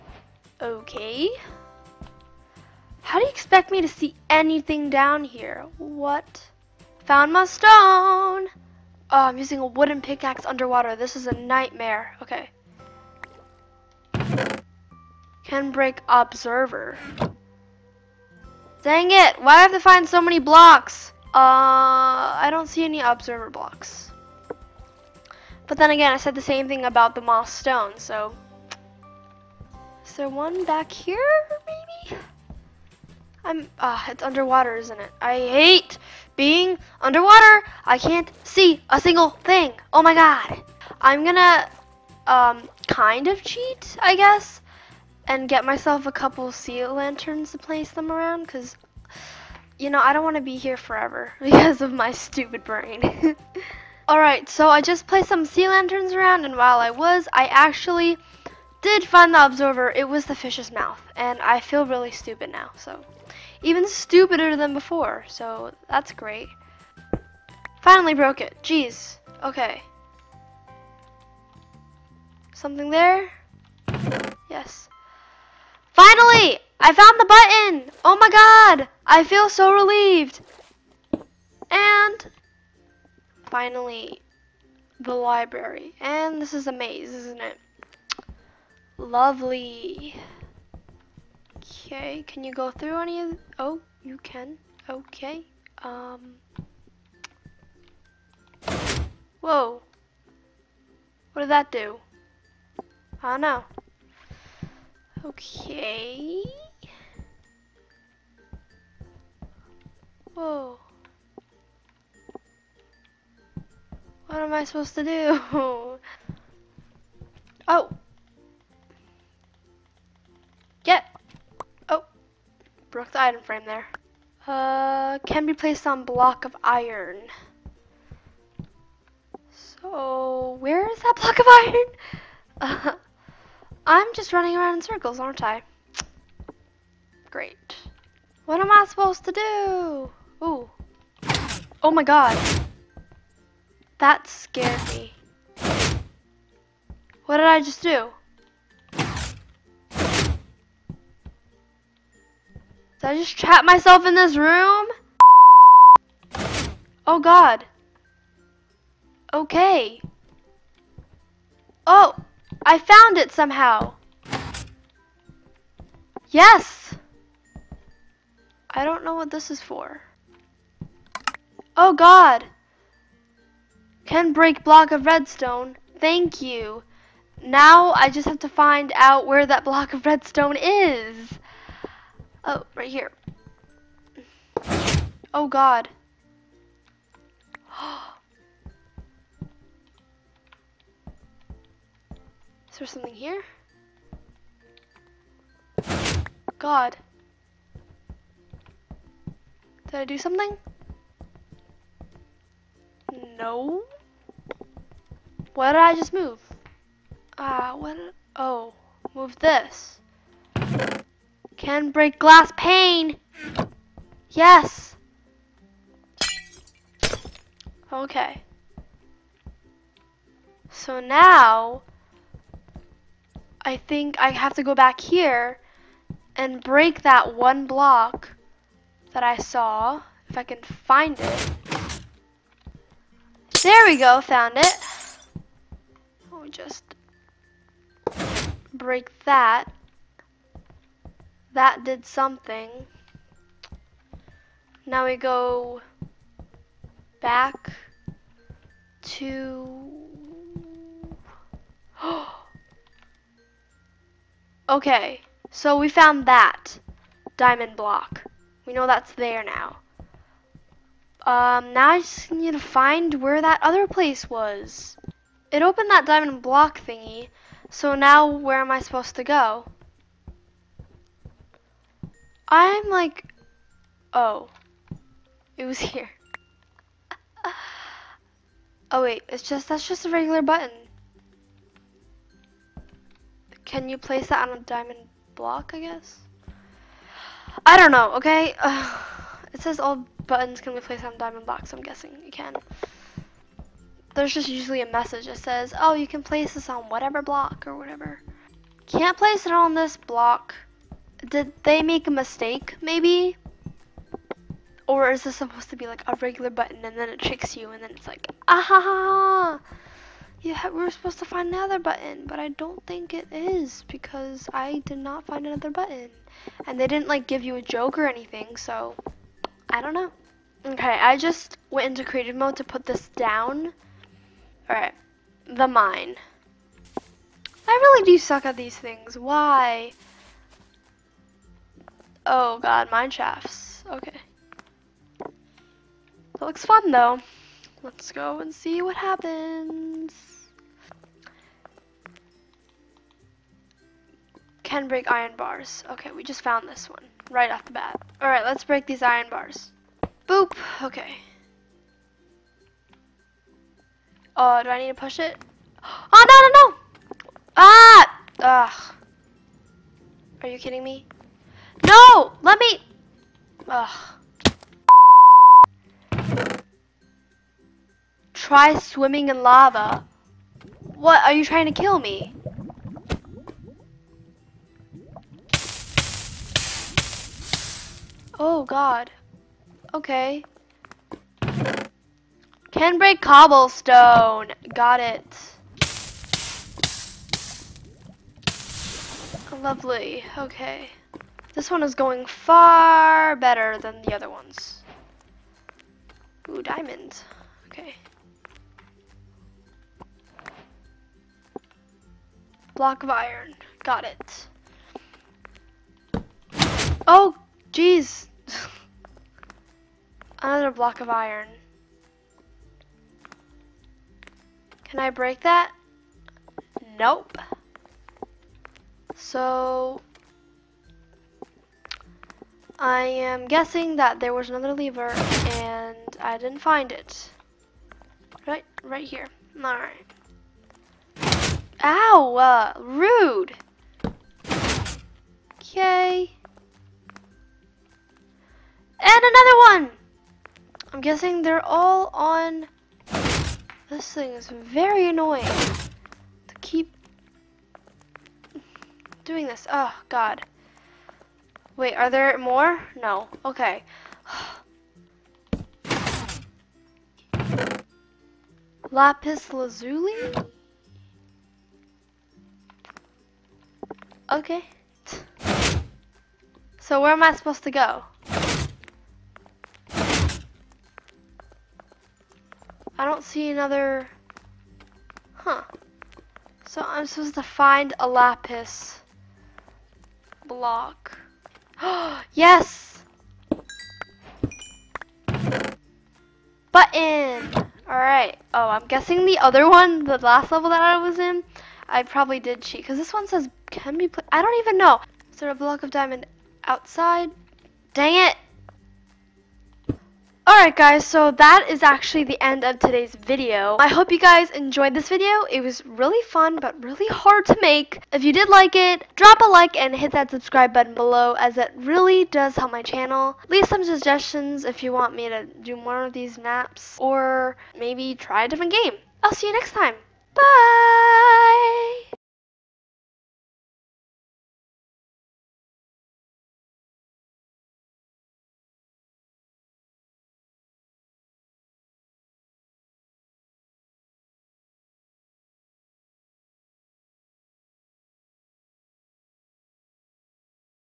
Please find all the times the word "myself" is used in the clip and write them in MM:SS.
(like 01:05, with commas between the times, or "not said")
00:45, 02:33.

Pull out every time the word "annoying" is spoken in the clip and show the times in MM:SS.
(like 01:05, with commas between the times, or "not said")
07:25.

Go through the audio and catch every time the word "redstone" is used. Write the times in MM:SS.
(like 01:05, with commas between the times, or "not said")
02:55, 03:00.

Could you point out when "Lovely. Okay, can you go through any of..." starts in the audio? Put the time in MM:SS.
01:28.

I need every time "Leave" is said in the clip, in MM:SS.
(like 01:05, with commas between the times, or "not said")
08:33.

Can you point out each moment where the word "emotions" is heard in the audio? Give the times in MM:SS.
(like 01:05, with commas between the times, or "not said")
not said.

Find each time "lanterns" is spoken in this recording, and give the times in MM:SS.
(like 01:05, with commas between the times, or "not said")
00:46, 00:55.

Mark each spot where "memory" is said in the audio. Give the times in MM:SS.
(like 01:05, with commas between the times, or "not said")
not said.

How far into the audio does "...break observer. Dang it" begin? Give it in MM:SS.
00:15.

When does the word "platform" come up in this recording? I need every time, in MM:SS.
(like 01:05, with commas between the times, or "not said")
not said.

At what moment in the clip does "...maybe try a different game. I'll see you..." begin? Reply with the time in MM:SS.
08:37.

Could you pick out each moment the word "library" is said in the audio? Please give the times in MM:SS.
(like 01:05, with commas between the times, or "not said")
01:25.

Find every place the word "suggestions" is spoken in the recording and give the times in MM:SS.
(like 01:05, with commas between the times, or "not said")
08:33.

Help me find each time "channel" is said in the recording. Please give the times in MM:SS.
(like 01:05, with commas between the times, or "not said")
08:32.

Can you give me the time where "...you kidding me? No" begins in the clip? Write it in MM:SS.
06:00.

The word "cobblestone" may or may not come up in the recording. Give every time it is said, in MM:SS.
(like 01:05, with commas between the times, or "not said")
06:23.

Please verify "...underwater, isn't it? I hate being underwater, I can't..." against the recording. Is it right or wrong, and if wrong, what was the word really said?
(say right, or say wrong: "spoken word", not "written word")
right.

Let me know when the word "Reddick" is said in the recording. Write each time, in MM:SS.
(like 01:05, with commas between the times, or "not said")
not said.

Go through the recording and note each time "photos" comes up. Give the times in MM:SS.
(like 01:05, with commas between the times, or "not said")
not said.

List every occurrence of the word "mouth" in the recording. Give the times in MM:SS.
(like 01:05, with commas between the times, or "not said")
01:00.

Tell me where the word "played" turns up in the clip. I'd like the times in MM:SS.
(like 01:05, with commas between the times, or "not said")
08:14.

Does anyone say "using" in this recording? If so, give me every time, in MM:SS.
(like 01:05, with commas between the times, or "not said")
00:09.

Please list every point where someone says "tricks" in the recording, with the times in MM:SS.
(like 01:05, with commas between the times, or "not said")
05:07.